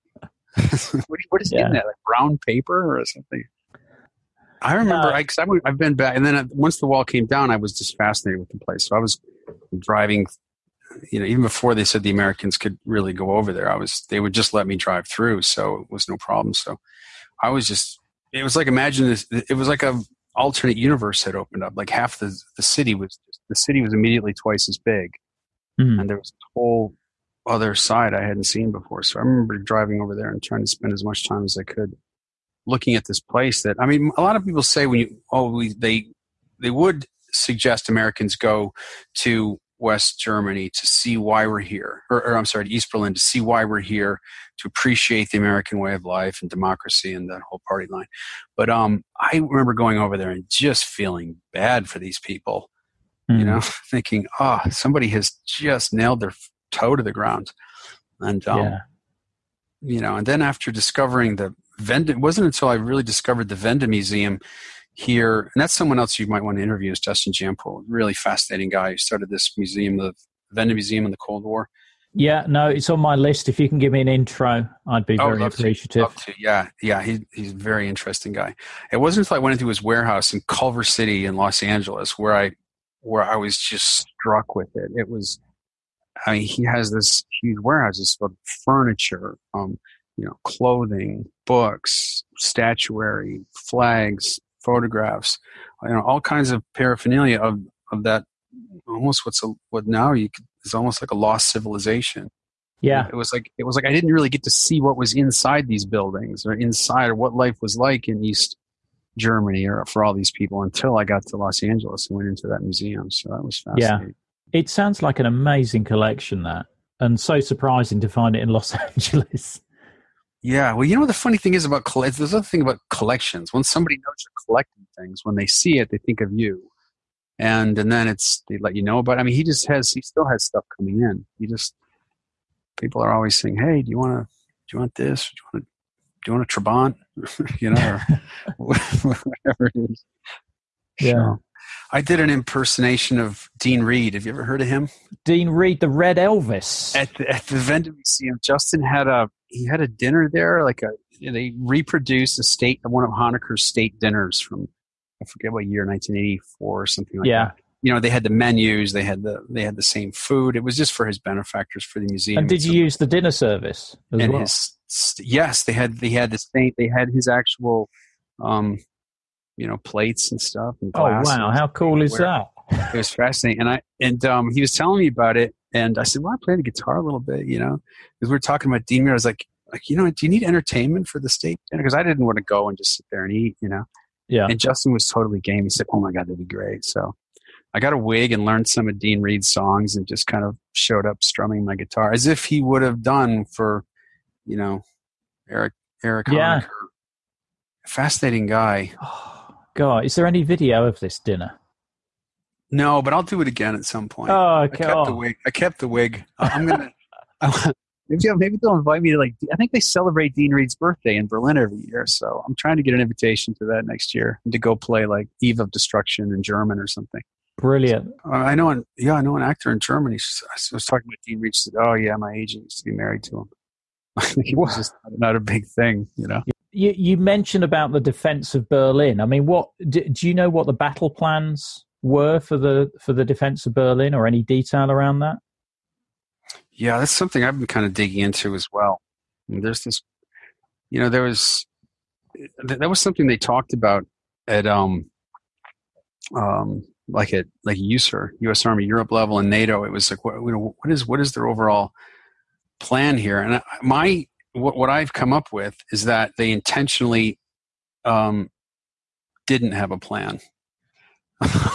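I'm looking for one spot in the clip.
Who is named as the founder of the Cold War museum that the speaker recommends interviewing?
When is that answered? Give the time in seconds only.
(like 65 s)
66 s.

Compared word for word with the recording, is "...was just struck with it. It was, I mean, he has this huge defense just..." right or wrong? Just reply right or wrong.
wrong.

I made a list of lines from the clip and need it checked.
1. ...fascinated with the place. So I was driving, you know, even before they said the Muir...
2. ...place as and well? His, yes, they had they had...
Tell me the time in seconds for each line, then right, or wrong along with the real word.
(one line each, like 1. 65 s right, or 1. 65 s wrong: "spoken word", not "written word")
1. 7 s wrong: "Americans", not "Muir"
2. 163 s wrong: "service", not "place".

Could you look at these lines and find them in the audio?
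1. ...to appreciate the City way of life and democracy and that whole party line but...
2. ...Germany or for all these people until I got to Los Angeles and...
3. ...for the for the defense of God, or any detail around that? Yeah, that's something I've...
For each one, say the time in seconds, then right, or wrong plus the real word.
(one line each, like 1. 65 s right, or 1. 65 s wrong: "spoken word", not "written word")
1. 44 s wrong: "American", not "City"
2. 109 s right
3. 232 s wrong: "Berlin", not "God".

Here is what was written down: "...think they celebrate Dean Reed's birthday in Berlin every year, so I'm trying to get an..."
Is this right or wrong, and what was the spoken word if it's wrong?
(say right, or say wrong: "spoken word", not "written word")
right.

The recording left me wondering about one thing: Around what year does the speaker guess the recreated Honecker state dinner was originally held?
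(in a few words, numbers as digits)
1984.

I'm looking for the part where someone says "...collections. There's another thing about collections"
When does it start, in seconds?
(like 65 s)
121 s.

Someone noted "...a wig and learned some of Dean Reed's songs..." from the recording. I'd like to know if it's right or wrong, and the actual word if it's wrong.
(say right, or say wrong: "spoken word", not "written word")
right.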